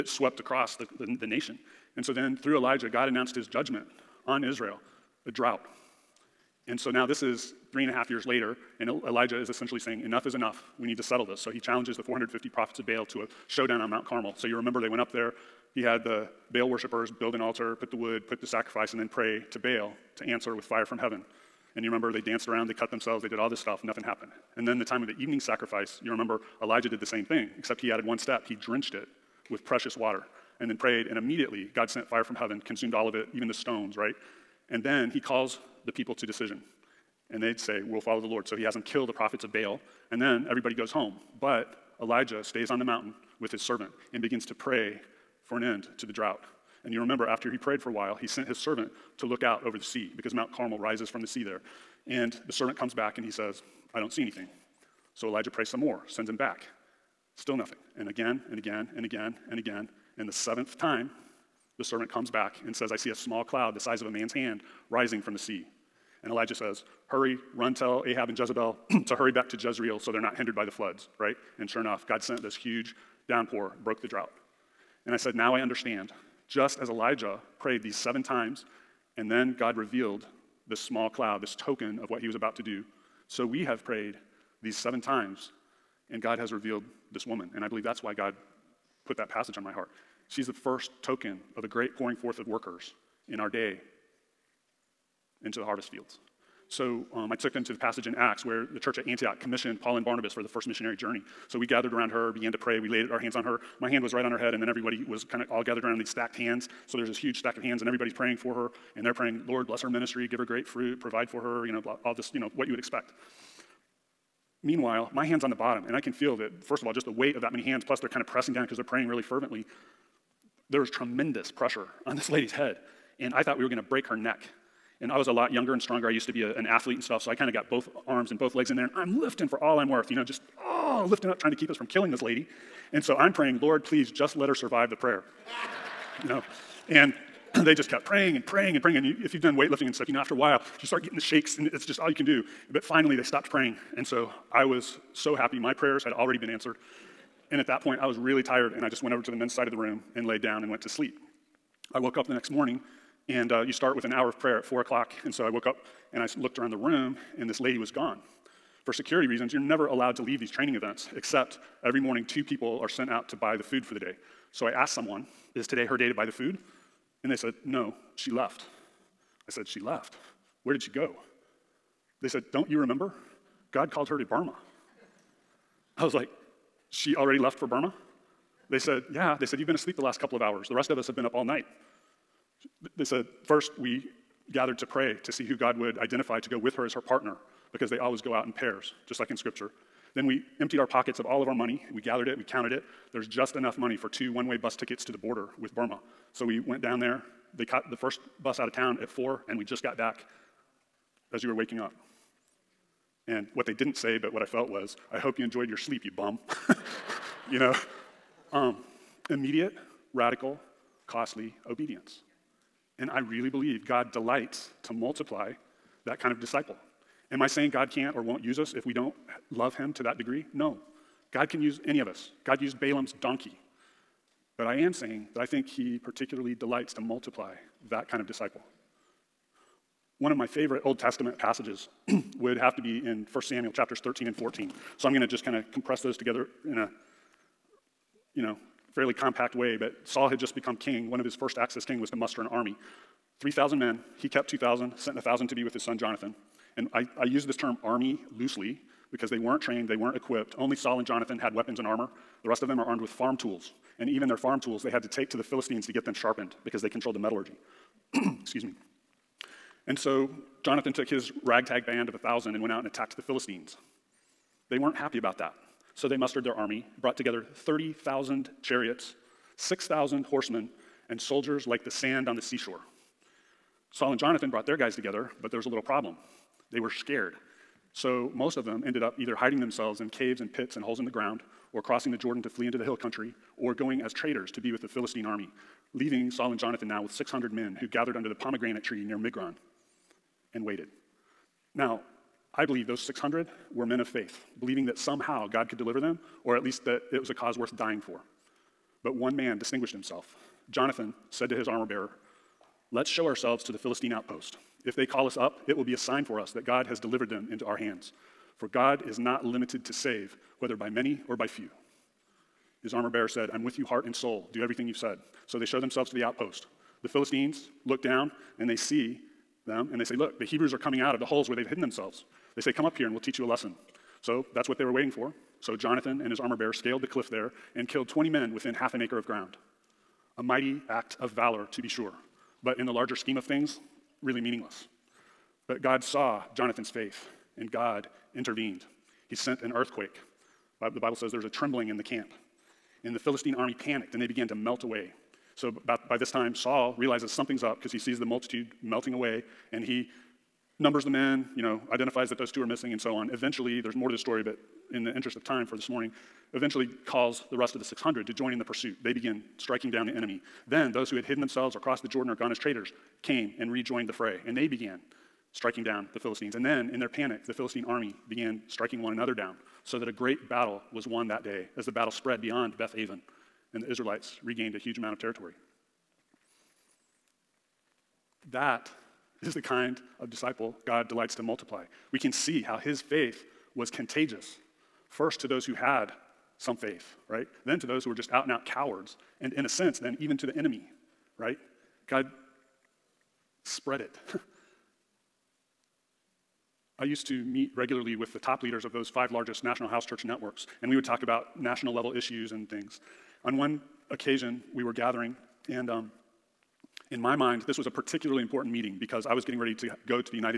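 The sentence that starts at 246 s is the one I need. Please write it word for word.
And I, I use this term army loosely because they weren't trained, they weren't equipped.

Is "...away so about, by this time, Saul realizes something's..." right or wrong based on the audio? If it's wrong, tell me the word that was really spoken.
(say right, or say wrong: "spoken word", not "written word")
right.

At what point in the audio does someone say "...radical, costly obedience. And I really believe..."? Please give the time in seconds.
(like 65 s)
210 s.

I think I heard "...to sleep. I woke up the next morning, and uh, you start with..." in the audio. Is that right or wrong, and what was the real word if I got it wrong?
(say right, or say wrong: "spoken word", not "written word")
right.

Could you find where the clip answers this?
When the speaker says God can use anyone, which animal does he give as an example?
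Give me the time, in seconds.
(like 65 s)
222 s.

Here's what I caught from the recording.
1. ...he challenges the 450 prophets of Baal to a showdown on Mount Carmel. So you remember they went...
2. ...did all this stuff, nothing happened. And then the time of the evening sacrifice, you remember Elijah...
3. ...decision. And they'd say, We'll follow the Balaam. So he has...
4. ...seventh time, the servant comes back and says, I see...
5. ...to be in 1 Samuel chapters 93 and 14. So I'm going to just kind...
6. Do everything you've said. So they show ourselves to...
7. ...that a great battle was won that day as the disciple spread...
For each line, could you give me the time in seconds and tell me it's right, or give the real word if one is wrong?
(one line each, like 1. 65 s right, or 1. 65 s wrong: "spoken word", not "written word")
1. 11 s right
2. 23 s right
3. 36 s wrong: "Lord", not "Balaam"
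4. 60 s right
5. 232 s wrong: "13", not "93"
6. 314 s wrong: "themselves", not "ourselves"
7. 369 s wrong: "battle", not "disciple".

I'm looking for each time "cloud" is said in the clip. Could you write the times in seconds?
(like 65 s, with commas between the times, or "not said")
63 s, 81 s.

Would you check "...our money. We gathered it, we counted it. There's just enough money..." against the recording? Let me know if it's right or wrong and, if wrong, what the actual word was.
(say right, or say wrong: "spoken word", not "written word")
right.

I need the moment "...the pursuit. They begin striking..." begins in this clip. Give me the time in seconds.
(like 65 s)
358 s.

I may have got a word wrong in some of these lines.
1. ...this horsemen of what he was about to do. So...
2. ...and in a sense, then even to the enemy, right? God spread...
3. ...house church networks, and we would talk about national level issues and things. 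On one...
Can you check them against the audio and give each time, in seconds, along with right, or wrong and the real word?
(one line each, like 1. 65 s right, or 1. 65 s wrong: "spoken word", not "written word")
1. 81 s wrong: "token", not "horsemen"
2. 389 s right
3. 399 s right.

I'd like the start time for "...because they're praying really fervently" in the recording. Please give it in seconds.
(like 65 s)
118 s.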